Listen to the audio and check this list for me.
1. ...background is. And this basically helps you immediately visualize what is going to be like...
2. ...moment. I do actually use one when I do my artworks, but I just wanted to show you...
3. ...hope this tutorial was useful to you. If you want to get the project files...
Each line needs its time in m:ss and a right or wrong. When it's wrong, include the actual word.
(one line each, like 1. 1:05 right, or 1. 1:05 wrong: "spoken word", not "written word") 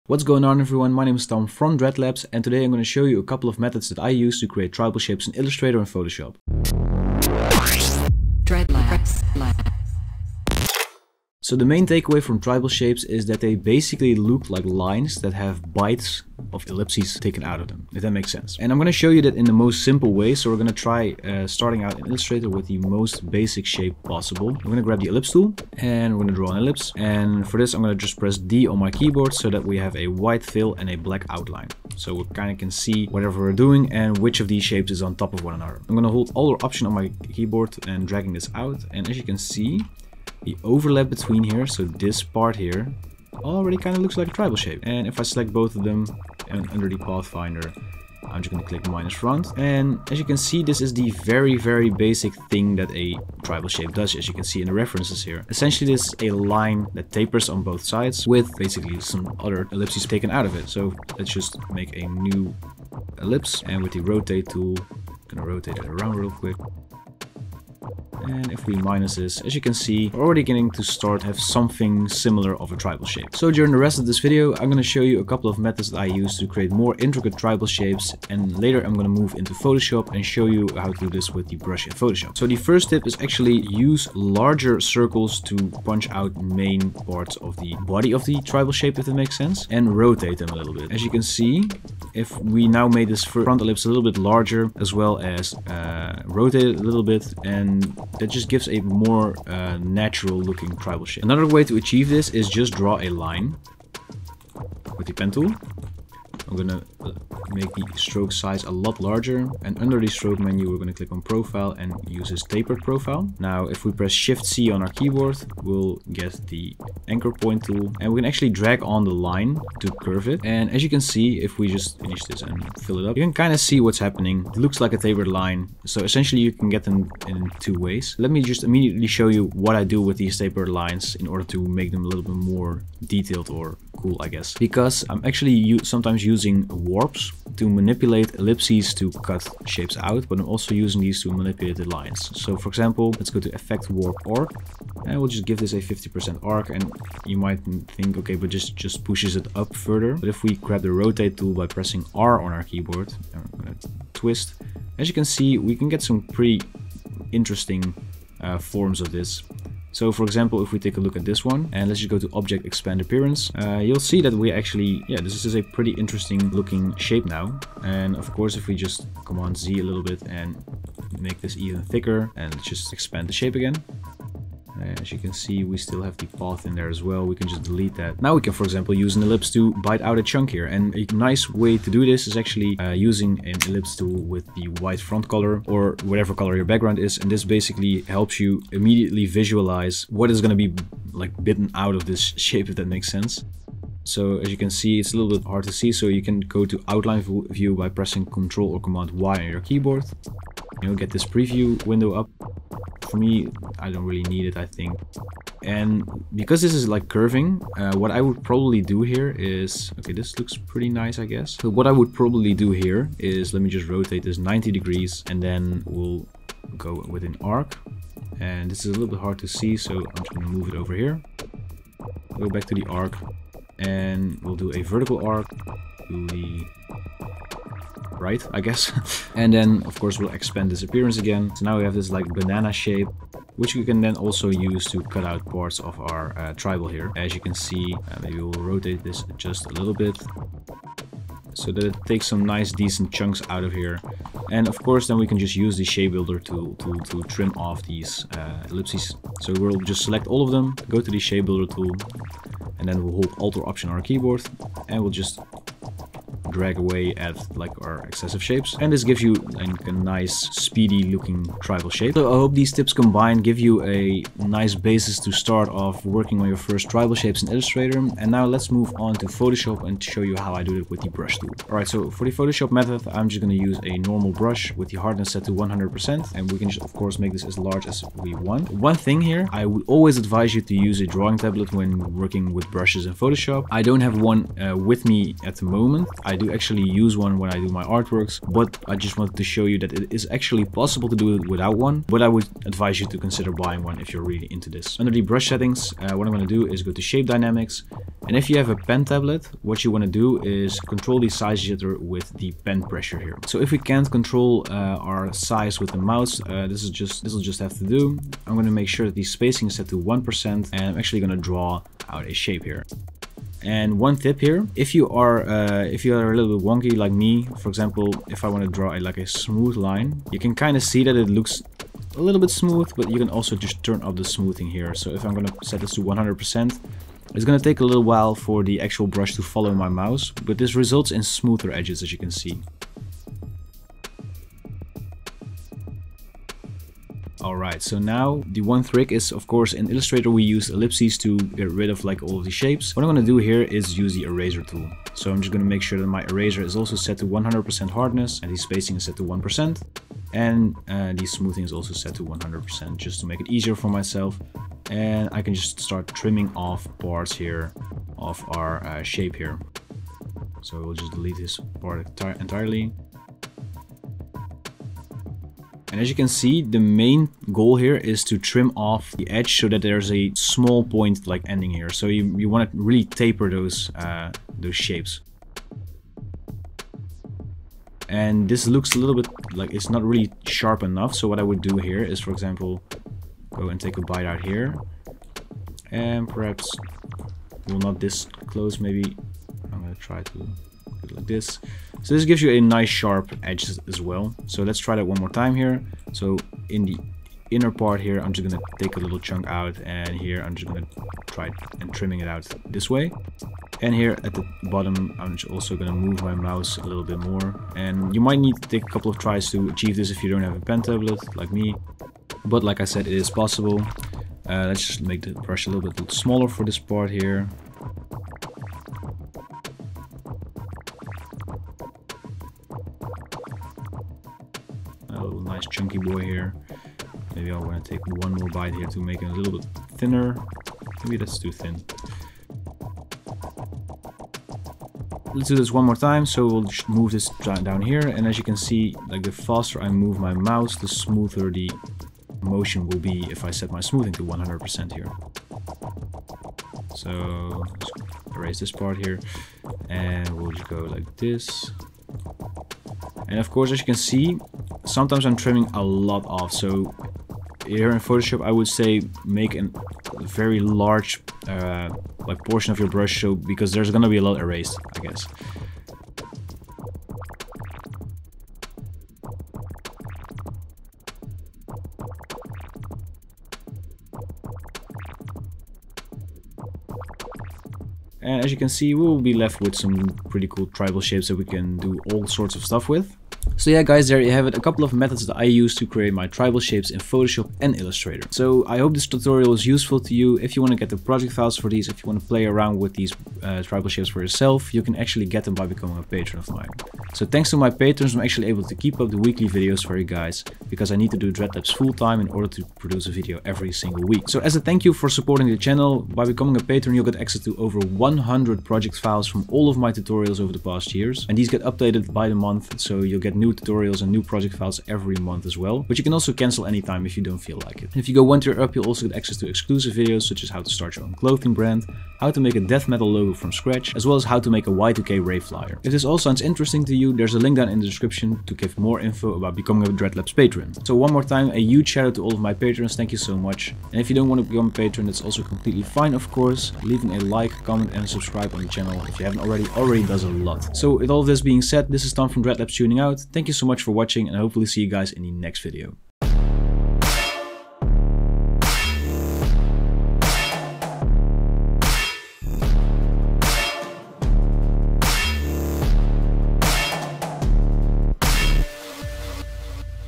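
1. 3:06 right
2. 4:45 right
3. 8:08 right.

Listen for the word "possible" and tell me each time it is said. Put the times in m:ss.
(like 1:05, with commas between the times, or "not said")
0:24, 4:50, 6:53.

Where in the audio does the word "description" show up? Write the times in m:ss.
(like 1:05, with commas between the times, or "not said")
8:47.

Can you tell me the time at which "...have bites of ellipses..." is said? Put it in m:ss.
0:15.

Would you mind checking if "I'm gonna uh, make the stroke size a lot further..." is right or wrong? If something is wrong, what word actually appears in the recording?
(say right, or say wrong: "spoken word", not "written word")
wrong: "larger", not "further".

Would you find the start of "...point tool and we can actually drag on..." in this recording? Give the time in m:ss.
1:57.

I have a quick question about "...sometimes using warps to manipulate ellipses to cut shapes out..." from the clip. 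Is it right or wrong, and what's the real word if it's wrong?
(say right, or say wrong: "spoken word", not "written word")
right.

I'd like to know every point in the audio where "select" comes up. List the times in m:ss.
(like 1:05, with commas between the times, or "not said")
0:45, 4:10.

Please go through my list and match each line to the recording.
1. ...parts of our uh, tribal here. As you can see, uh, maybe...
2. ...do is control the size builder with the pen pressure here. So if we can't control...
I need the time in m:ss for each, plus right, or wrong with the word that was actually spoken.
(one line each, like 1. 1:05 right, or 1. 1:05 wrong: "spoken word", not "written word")
1. 3:55 right
2. 5:00 wrong: "jitter", not "builder".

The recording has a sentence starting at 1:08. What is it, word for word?
And if we minus this, as you can see, we're already getting to start have something similar of a tribal shape.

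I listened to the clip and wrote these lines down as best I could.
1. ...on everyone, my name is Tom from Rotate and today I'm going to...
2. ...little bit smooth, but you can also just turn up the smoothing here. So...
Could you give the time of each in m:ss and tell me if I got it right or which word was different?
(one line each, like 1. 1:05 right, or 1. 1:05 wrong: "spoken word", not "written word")
1. 0:00 wrong: "Dreadlabs", not "Rotate"
2. 5:22 right.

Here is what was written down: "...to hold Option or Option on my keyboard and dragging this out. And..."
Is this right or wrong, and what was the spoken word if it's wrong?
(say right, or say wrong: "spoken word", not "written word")
wrong: "Alt", not "Option".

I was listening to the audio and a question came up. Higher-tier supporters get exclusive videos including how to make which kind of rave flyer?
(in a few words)
Y2K.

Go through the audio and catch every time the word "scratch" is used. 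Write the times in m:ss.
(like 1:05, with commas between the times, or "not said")
8:43.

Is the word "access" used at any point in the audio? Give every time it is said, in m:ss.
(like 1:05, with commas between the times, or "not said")
8:27, 8:39.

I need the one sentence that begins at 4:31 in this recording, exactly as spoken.
Alright, so for the Photoshop method, I'm just going to use a normal brush with the hardness set to 100%.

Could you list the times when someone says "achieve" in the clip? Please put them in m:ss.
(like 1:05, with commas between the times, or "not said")
1:41, 6:49.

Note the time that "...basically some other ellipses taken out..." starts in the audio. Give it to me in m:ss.
0:58.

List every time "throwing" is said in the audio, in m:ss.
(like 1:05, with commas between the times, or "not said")
not said.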